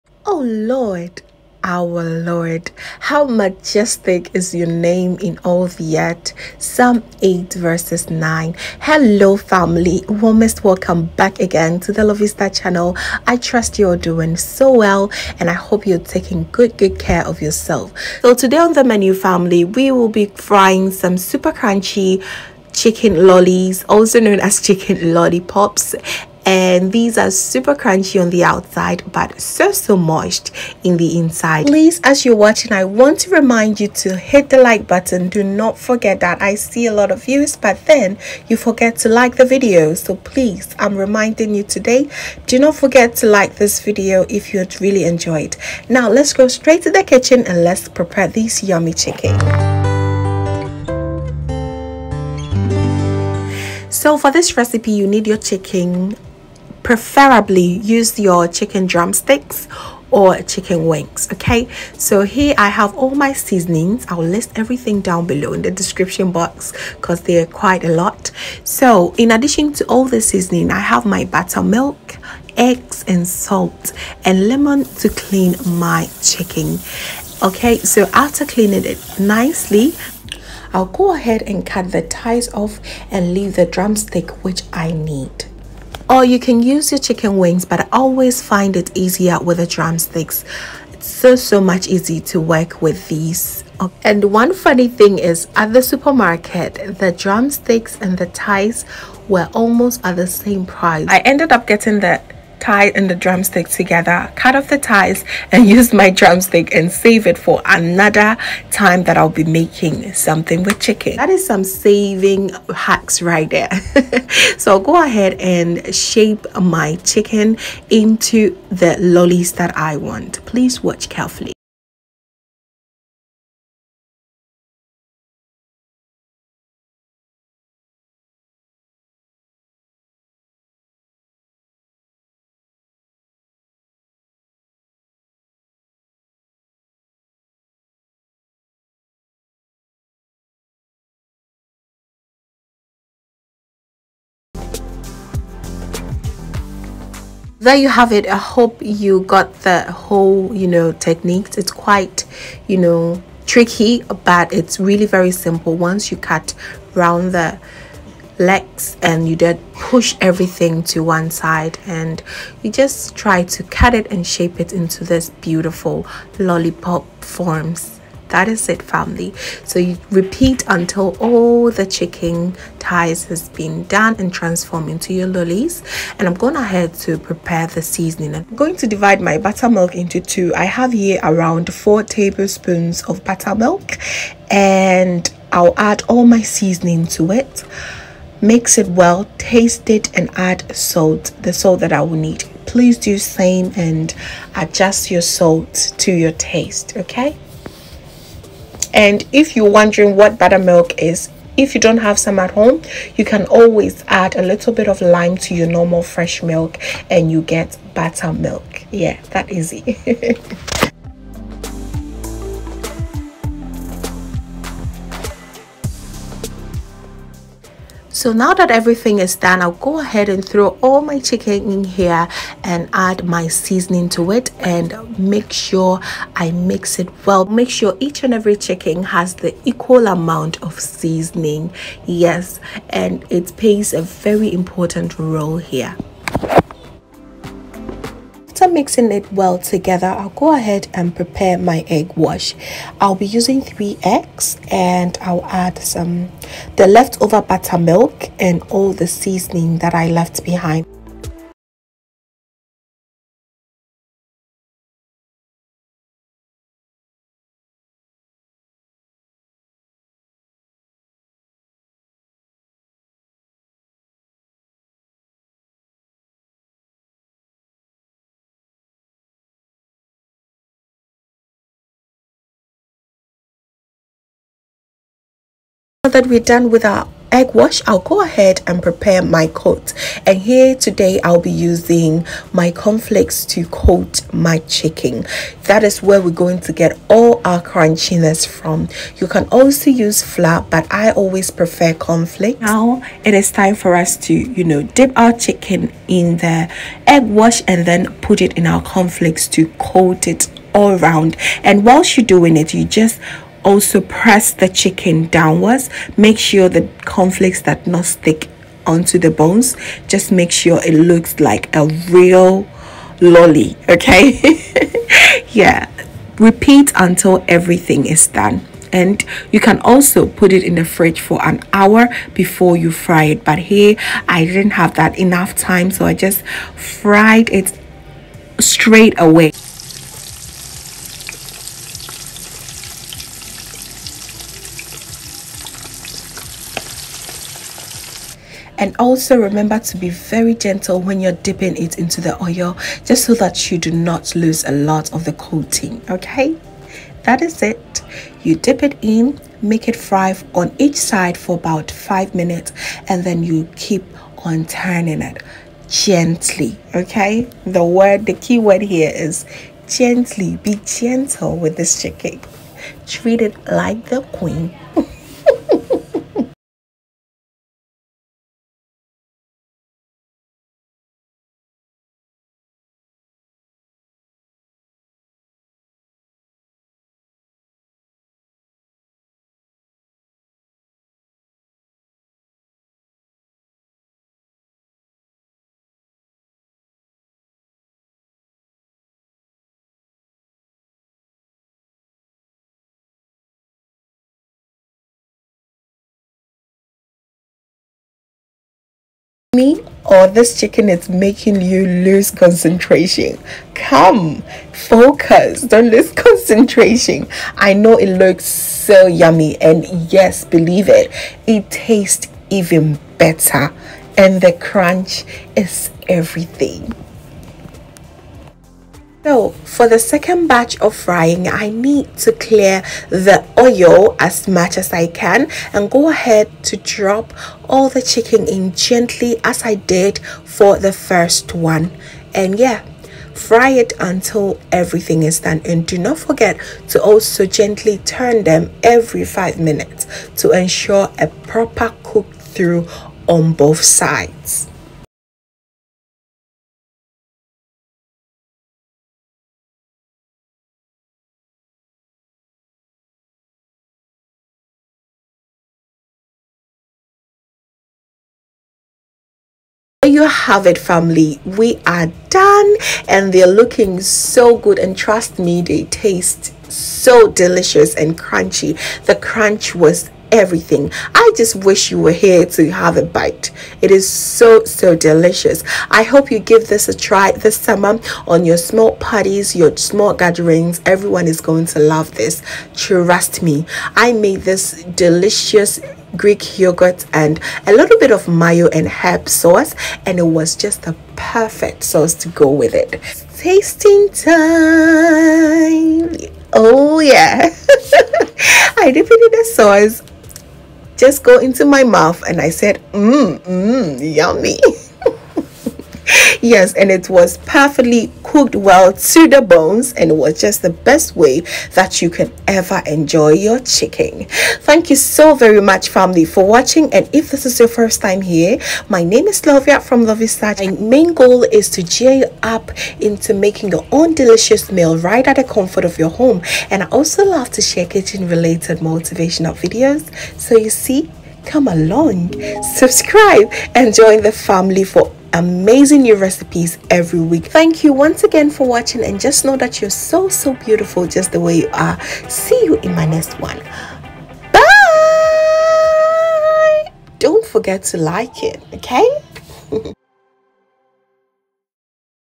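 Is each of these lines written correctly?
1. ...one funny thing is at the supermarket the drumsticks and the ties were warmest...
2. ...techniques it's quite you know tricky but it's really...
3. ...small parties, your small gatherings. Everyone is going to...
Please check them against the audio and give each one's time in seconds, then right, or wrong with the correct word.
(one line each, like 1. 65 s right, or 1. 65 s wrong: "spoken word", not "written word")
1. 94 s wrong: "almost", not "warmest"
2. 150 s right
3. 478 s right.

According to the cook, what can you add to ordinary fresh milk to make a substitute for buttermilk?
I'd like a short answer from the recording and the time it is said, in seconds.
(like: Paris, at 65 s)
Lime, at 205 s.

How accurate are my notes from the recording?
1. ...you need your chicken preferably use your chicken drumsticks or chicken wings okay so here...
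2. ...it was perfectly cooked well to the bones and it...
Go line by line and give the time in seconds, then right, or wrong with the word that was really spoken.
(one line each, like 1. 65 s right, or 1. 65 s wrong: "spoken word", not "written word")
1. 54 s right
2. 506 s right.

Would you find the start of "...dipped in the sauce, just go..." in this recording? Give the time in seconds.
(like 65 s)
498 s.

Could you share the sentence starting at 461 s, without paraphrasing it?
We are done and they're looking so good.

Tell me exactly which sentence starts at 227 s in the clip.
Make sure each and every chicken has the equal amount of seasoning.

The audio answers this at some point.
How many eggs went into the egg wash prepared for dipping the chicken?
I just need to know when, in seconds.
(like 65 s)
243 s.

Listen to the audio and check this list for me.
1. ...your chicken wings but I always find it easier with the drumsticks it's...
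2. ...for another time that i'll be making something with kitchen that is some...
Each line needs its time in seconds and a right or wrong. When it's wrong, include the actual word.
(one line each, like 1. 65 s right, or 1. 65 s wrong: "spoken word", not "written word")
1. 86 s right
2. 107 s wrong: "chicken", not "kitchen".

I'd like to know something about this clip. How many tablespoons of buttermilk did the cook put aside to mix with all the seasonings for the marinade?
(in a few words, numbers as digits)
4.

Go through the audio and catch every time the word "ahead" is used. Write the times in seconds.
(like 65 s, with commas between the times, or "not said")
81 s, 115 s, 176 s, 219 s, 240 s, 278 s, 426 s.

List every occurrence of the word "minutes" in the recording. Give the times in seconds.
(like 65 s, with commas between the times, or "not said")
352 s, 439 s.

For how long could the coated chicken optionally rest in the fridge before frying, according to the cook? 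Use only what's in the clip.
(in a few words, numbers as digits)
An hour.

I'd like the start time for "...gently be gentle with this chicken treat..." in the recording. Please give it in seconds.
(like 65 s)
359 s.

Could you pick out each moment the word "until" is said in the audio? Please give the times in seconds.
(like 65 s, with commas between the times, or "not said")
170 s, 316 s, 433 s.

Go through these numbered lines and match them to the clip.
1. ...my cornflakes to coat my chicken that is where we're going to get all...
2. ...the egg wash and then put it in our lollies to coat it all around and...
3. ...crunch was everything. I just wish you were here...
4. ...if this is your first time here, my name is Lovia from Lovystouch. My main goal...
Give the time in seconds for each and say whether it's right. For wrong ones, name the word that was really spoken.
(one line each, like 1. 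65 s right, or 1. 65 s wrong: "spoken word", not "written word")
1. 282 s right
2. 296 s wrong: "cornflakes", not "lollies"
3. 469 s right
4. 517 s right.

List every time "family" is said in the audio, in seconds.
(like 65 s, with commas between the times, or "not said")
9 s, 19 s, 168 s, 460 s, 515 s, 534 s.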